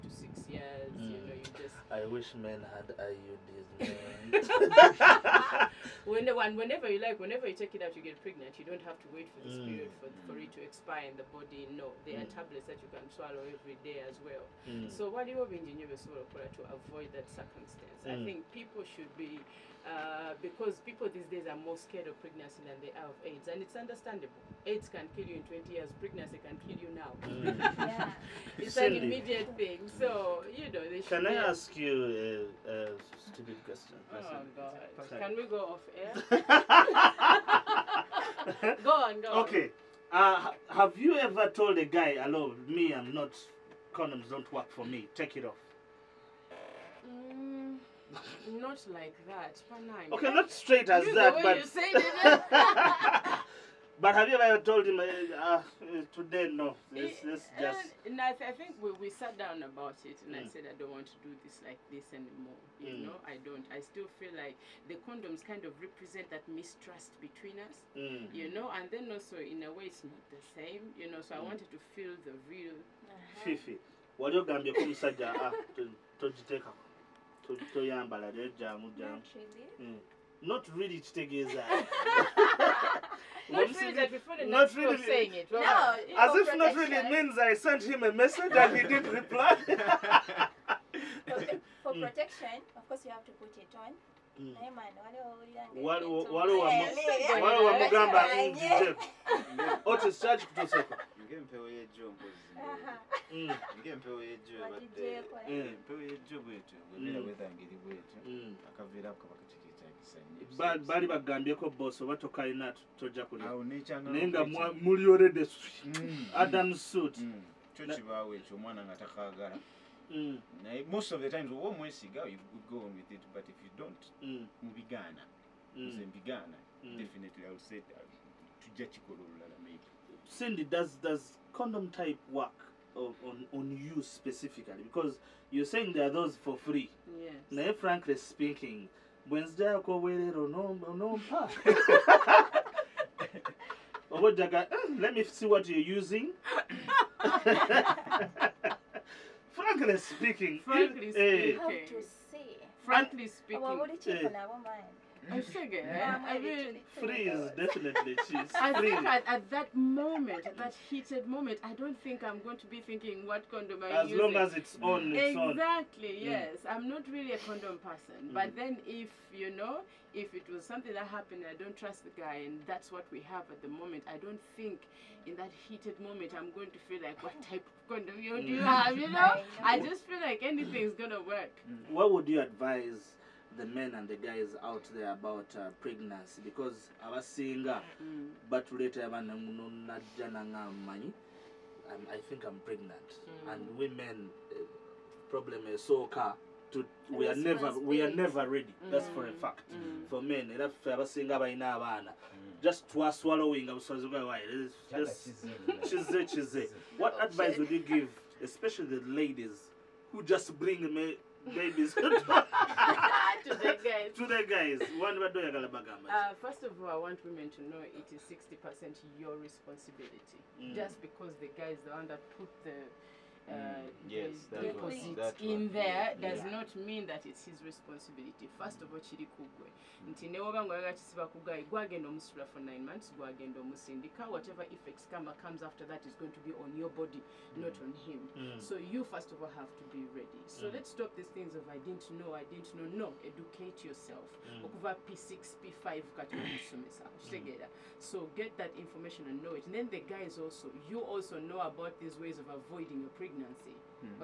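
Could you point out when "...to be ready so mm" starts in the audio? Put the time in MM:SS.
03:59.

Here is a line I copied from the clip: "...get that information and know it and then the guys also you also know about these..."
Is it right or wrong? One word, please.
right.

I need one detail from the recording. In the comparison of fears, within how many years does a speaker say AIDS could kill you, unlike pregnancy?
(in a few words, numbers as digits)
20 years.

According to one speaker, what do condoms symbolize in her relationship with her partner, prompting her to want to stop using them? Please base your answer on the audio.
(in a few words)
Mistrust.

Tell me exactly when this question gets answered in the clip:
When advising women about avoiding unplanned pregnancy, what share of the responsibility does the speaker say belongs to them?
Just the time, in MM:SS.
03:38.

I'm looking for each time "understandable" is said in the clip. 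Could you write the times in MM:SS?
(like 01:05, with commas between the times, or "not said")
00:23.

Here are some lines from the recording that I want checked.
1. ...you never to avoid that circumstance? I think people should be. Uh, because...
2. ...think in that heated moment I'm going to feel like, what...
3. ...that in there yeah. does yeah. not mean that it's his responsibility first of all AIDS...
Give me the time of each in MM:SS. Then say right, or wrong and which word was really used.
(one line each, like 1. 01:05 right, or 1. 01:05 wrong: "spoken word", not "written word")
1. 00:15 wrong: "engineer", not "never"
2. 02:54 right
3. 03:45 wrong: "Chiri", not "AIDS".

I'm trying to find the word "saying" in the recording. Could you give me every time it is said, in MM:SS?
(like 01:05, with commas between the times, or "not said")
01:25, 02:15.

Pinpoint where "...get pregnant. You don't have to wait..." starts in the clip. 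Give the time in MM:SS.
00:08.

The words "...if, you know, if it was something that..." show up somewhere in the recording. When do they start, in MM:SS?
02:48.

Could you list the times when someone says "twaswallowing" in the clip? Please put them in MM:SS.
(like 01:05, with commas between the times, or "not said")
03:22.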